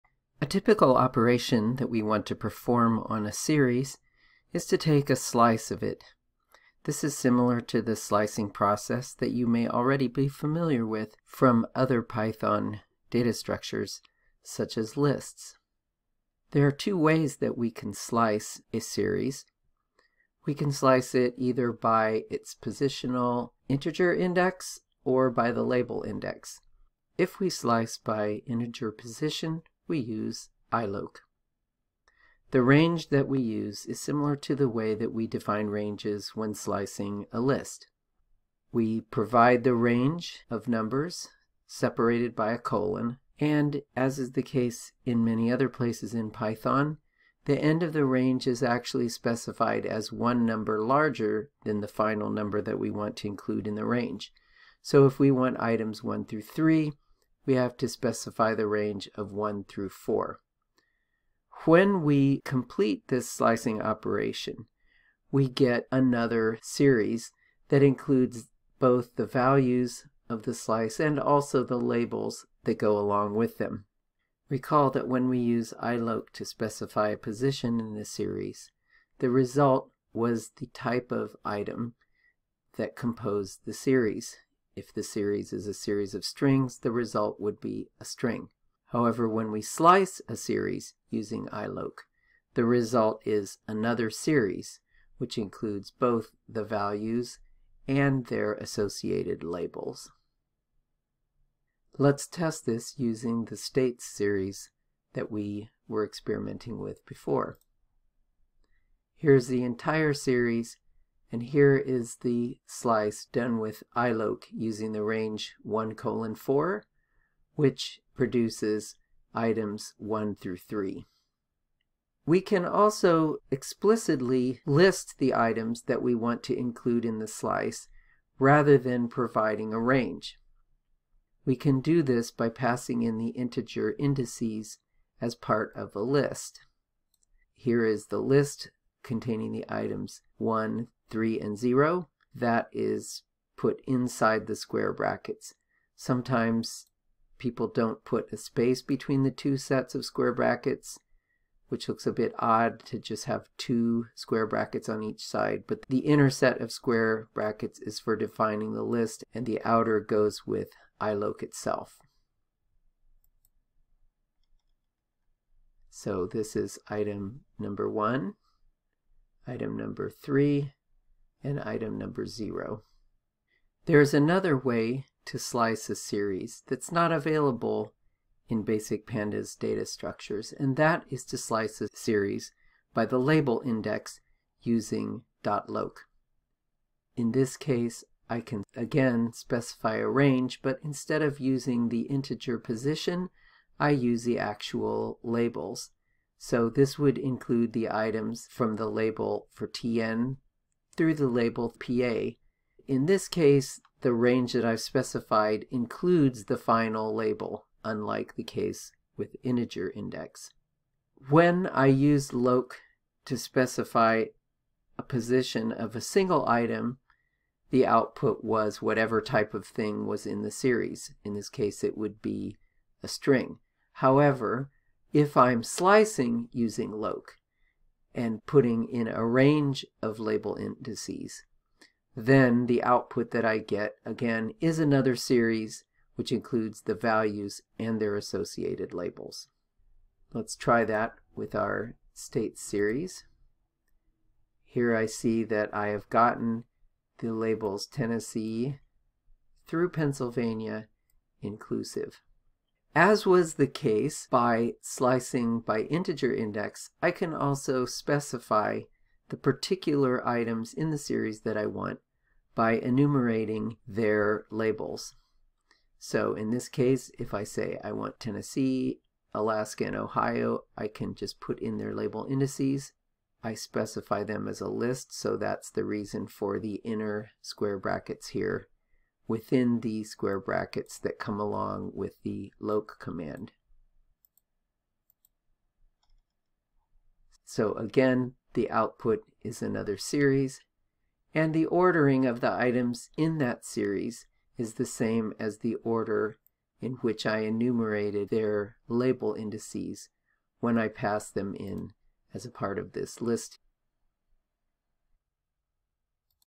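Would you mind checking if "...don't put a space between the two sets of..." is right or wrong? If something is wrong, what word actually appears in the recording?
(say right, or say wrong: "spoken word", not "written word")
right.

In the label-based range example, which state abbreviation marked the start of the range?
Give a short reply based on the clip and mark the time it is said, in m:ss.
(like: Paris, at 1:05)
TN, at 3:19.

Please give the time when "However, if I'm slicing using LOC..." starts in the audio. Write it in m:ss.
3:43.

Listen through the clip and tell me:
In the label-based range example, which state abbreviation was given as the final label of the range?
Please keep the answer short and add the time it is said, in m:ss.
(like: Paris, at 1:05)
PA, at 3:21.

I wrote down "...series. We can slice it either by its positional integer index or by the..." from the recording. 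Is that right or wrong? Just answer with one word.
right.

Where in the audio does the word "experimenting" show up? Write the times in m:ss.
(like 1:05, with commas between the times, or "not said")
1:46.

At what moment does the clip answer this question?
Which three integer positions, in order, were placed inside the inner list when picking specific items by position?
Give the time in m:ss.
2:20.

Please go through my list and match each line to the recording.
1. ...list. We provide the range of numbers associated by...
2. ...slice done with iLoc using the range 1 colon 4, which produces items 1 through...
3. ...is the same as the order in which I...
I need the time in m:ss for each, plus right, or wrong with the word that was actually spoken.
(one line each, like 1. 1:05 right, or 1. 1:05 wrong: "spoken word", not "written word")
1. 0:37 wrong: "separated", not "associated"
2. 1:52 right
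3. 4:54 right.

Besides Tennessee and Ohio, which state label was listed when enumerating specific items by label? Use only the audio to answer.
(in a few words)
Alaska.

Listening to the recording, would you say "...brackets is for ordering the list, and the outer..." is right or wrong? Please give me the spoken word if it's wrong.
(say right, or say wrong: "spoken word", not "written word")
wrong: "defining", not "ordering".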